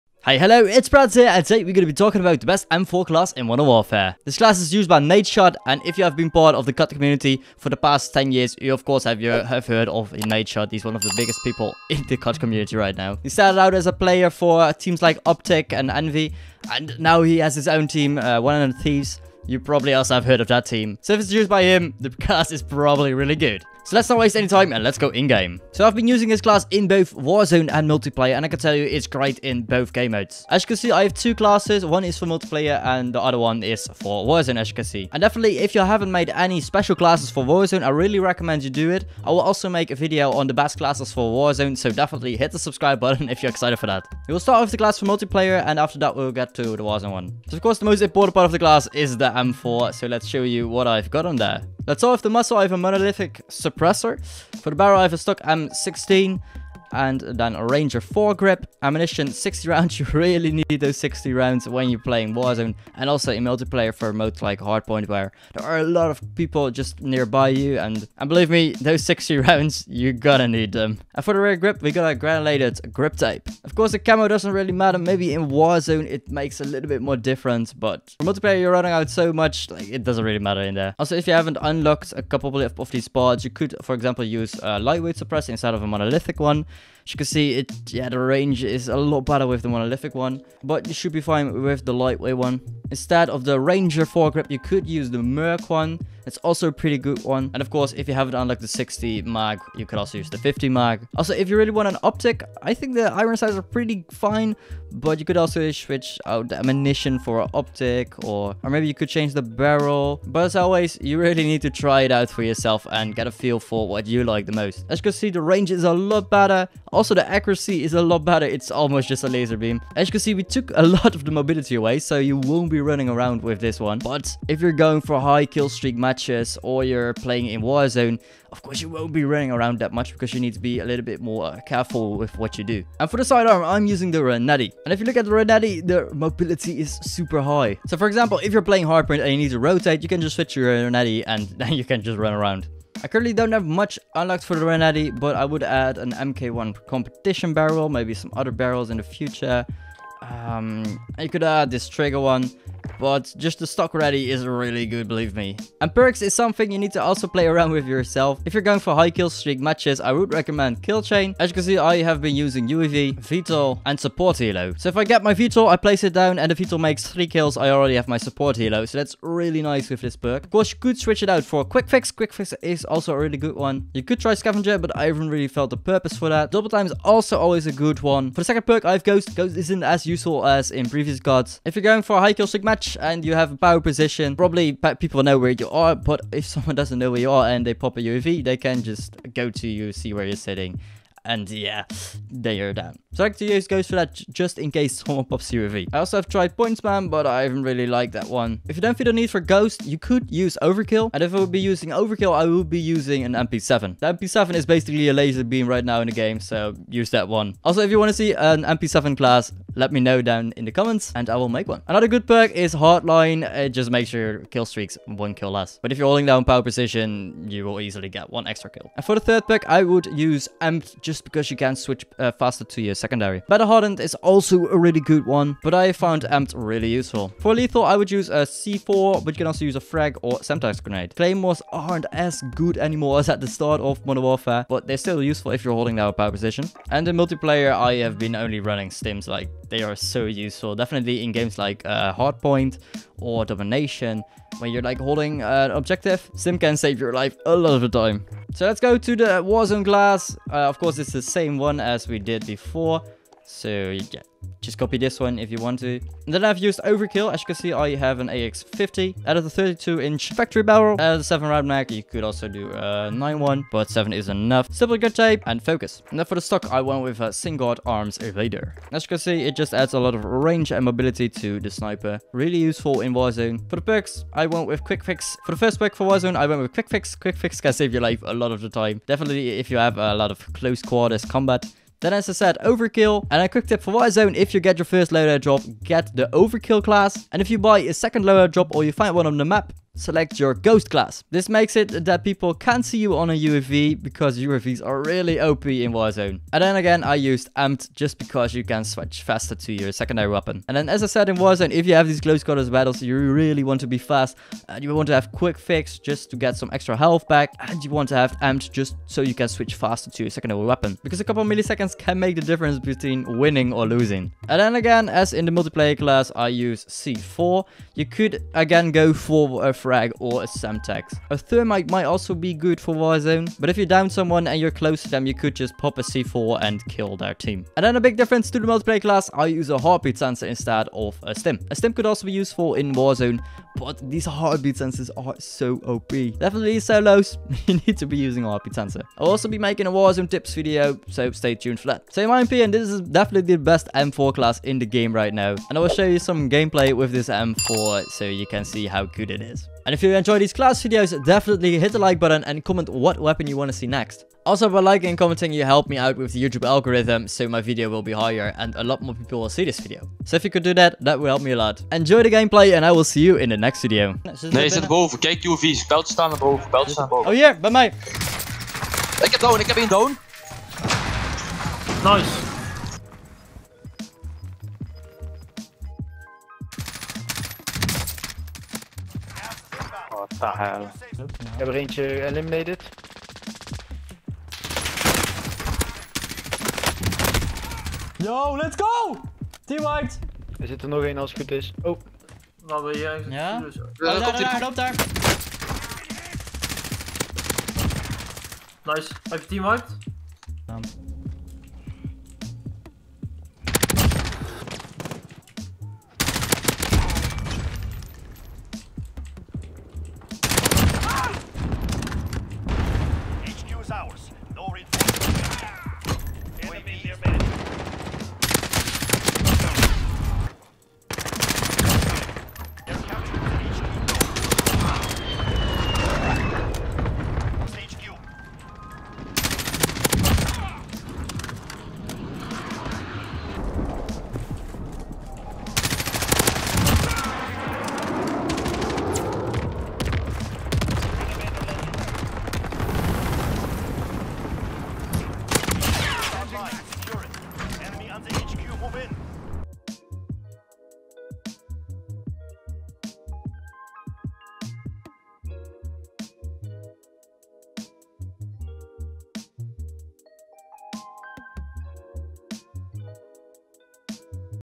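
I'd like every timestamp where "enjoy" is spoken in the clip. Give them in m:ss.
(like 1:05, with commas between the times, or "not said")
5:50, 6:01.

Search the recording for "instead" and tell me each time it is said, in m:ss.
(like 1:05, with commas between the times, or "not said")
1:25, 1:32, 5:30.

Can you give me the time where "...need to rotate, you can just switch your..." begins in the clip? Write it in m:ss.
2:19.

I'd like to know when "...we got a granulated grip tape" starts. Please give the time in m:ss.
1:11.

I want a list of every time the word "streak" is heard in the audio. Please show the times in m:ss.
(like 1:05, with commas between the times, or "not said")
2:05, 2:39, 3:02, 3:34.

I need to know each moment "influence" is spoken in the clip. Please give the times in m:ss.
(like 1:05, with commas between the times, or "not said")
not said.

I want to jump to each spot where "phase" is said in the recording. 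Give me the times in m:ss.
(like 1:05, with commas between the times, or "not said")
not said.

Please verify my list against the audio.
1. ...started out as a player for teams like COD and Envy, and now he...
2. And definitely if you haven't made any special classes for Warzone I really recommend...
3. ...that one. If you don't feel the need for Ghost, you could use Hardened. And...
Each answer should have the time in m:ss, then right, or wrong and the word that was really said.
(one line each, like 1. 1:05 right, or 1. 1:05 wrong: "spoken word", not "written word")
1. 0:13 wrong: "Optic", not "COD"
2. 0:35 right
3. 3:18 wrong: "Overkill", not "Hardened".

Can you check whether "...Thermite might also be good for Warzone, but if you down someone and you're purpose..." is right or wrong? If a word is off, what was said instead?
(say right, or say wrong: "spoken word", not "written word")
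wrong: "close", not "purpose".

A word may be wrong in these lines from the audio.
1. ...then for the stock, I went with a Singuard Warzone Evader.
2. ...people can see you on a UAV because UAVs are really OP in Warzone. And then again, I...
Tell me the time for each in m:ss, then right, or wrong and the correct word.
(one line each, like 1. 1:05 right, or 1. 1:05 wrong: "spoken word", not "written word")
1. 4:26 wrong: "Arms", not "Warzone"
2. 4:52 right.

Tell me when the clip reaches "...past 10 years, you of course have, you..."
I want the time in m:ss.
0:07.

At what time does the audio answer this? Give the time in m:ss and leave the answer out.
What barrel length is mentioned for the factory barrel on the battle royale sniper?
4:19.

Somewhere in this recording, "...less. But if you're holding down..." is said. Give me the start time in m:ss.
3:35.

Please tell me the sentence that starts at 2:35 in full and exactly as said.
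And perks is something you need to also play around with yourself.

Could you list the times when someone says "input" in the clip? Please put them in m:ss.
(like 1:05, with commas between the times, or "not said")
not said.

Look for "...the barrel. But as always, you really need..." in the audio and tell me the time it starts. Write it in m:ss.
1:49.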